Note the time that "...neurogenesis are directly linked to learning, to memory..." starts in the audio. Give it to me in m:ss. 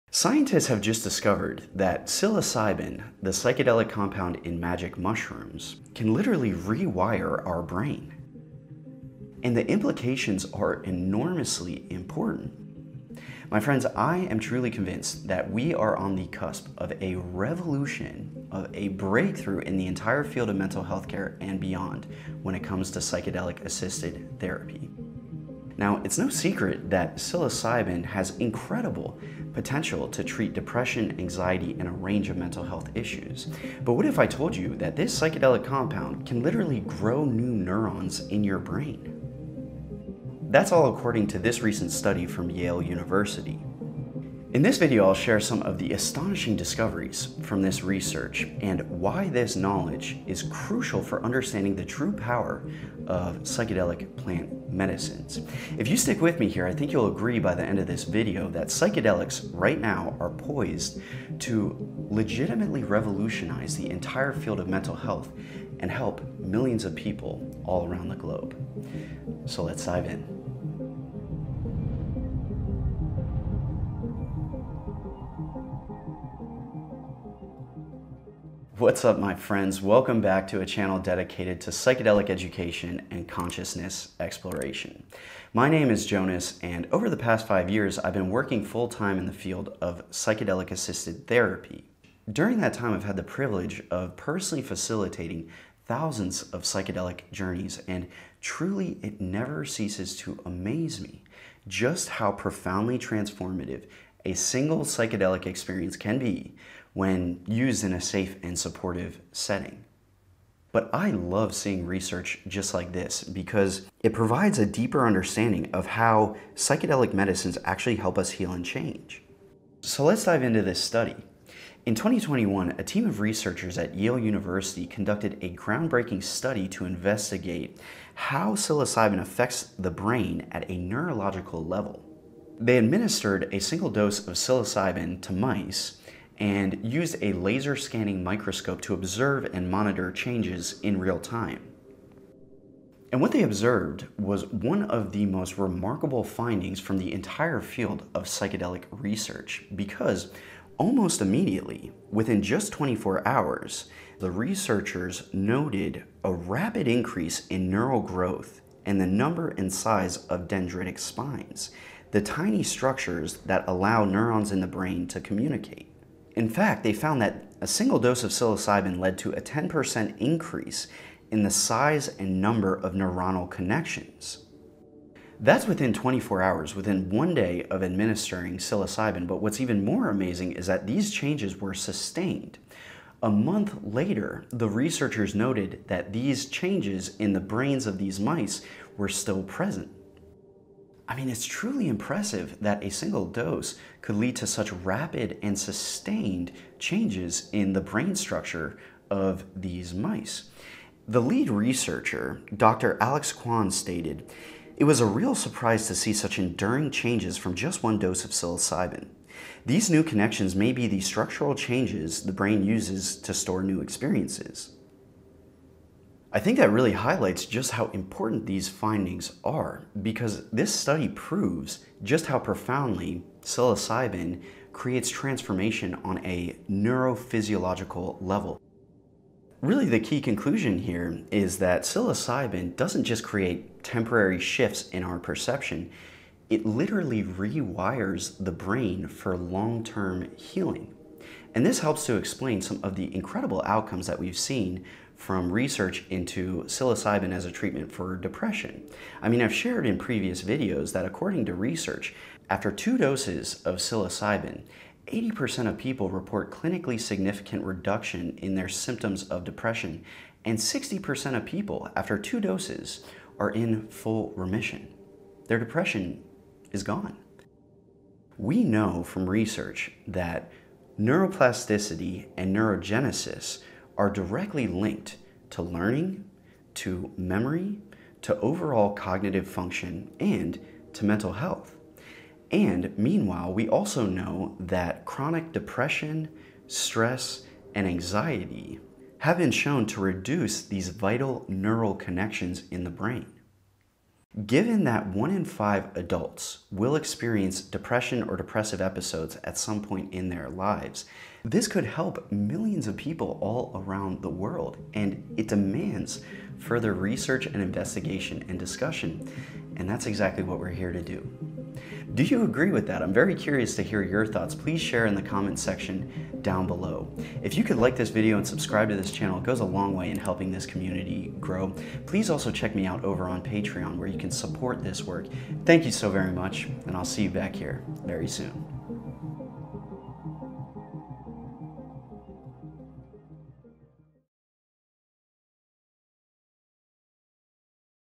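4:32.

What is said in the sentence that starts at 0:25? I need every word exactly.
Now, it's no secret that psilocybin has incredible potential to treat depression, anxiety, and a range of mental health issues.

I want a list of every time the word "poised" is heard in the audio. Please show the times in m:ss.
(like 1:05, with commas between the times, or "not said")
1:00.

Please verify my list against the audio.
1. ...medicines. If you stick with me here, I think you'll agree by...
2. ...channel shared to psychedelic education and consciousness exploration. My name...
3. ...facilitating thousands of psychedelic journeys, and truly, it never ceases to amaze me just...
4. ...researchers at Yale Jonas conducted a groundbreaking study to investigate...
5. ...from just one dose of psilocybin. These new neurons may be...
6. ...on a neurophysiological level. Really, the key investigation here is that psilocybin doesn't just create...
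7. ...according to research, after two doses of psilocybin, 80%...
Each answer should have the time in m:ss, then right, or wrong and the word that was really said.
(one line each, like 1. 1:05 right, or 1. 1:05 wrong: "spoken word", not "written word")
1. 0:54 right
2. 1:20 wrong: "dedicated", not "shared"
3. 1:34 right
4. 2:03 wrong: "University", not "Jonas"
5. 3:27 wrong: "connections", not "neurons"
6. 3:46 wrong: "conclusion", not "investigation"
7. 4:11 right.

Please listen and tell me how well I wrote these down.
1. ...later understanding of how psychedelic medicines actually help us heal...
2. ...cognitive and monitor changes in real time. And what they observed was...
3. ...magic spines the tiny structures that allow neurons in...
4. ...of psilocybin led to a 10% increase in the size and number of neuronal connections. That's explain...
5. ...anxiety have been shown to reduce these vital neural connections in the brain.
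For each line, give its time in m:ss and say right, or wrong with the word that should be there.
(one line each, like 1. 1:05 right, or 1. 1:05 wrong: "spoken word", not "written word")
1. 1:54 wrong: "deeper", not "later"
2. 2:18 wrong: "observe", not "cognitive"
3. 2:40 wrong: "dendritic", not "magic"
4. 2:48 wrong: "within", not "explain"
5. 4:47 right.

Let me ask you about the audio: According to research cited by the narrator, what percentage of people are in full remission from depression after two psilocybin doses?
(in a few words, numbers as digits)
60%.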